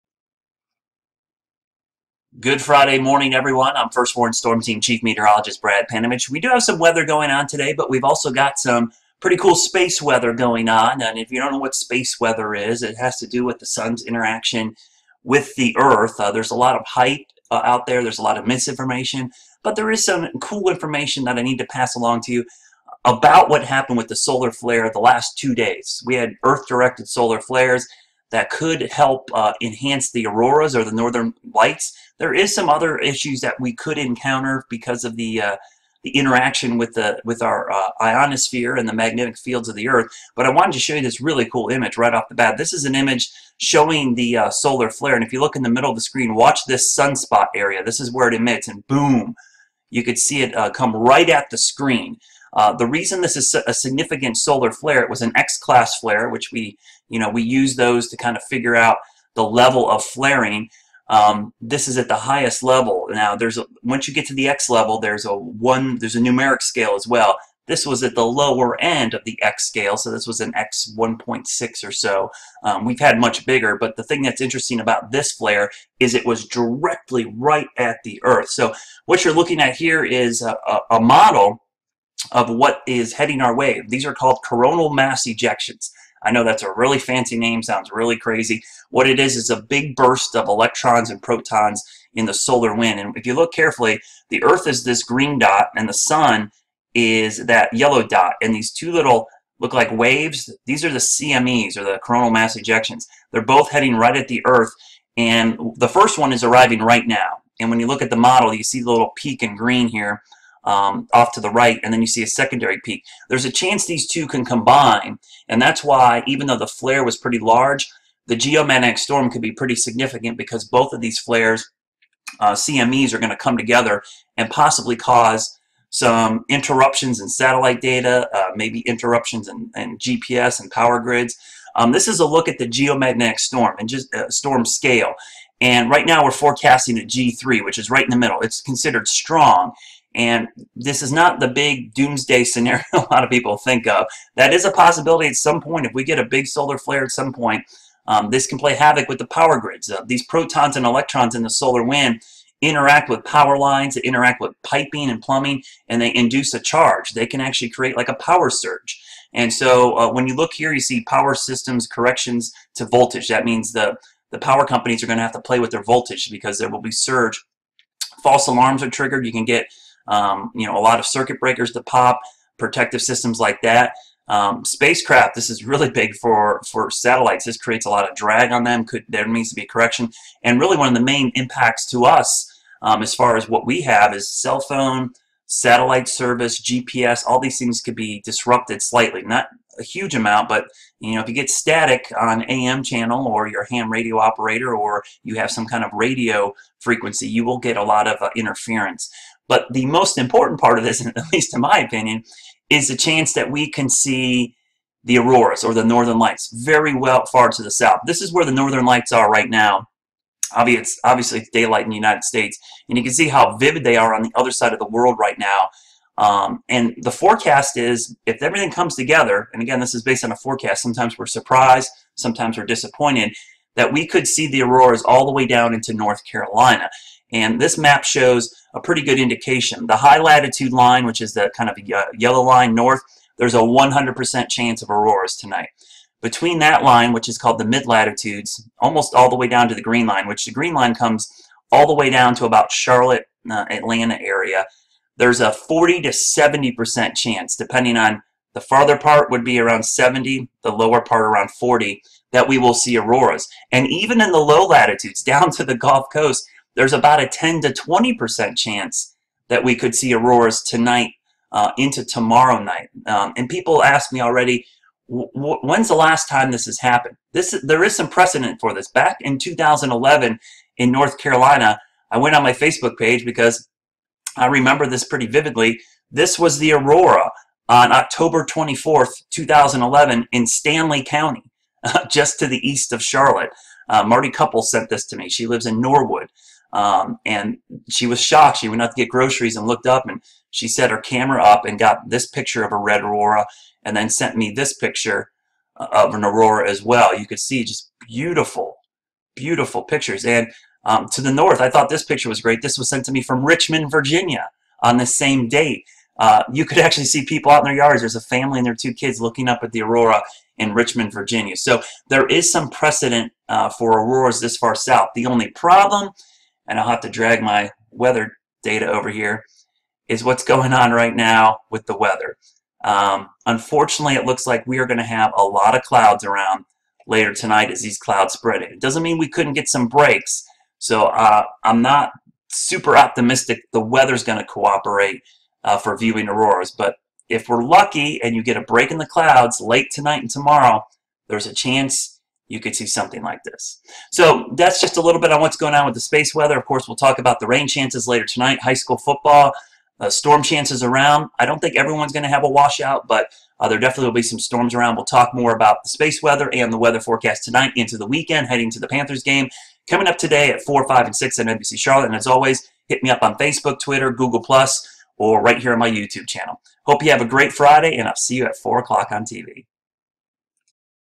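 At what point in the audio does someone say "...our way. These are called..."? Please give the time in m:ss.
1:23.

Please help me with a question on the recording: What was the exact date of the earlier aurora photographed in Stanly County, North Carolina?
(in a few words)
October 24th, 2011.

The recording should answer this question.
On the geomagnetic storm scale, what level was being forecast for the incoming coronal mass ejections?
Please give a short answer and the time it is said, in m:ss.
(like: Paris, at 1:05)
G3, at 2:17.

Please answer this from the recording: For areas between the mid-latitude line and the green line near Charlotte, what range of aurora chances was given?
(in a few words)
40 to 70%.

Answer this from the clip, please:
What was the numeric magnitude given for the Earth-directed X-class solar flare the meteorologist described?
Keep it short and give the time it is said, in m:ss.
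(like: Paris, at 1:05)
X1.6, at 1:10.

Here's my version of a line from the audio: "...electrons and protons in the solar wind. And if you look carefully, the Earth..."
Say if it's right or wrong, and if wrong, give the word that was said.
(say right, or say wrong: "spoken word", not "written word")
right.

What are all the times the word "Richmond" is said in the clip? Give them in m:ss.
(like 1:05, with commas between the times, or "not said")
5:03, 5:10.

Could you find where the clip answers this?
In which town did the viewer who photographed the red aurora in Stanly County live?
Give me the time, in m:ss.
4:45.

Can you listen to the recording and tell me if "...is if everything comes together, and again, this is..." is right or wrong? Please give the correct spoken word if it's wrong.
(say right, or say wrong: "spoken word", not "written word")
right.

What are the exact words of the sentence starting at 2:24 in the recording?
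That is a possibility at some point.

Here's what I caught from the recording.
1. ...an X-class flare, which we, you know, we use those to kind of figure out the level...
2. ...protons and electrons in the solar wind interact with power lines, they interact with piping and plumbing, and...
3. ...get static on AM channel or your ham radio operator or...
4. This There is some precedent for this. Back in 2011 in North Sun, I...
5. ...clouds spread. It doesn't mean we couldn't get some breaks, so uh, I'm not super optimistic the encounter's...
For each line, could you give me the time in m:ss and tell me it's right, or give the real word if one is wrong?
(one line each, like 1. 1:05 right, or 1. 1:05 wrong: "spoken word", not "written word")
1. 0:55 right
2. 2:30 right
3. 3:11 right
4. 4:27 wrong: "Carolina", not "Sun"
5. 5:27 wrong: "weather", not "encounter".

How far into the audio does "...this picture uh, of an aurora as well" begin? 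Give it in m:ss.
4:54.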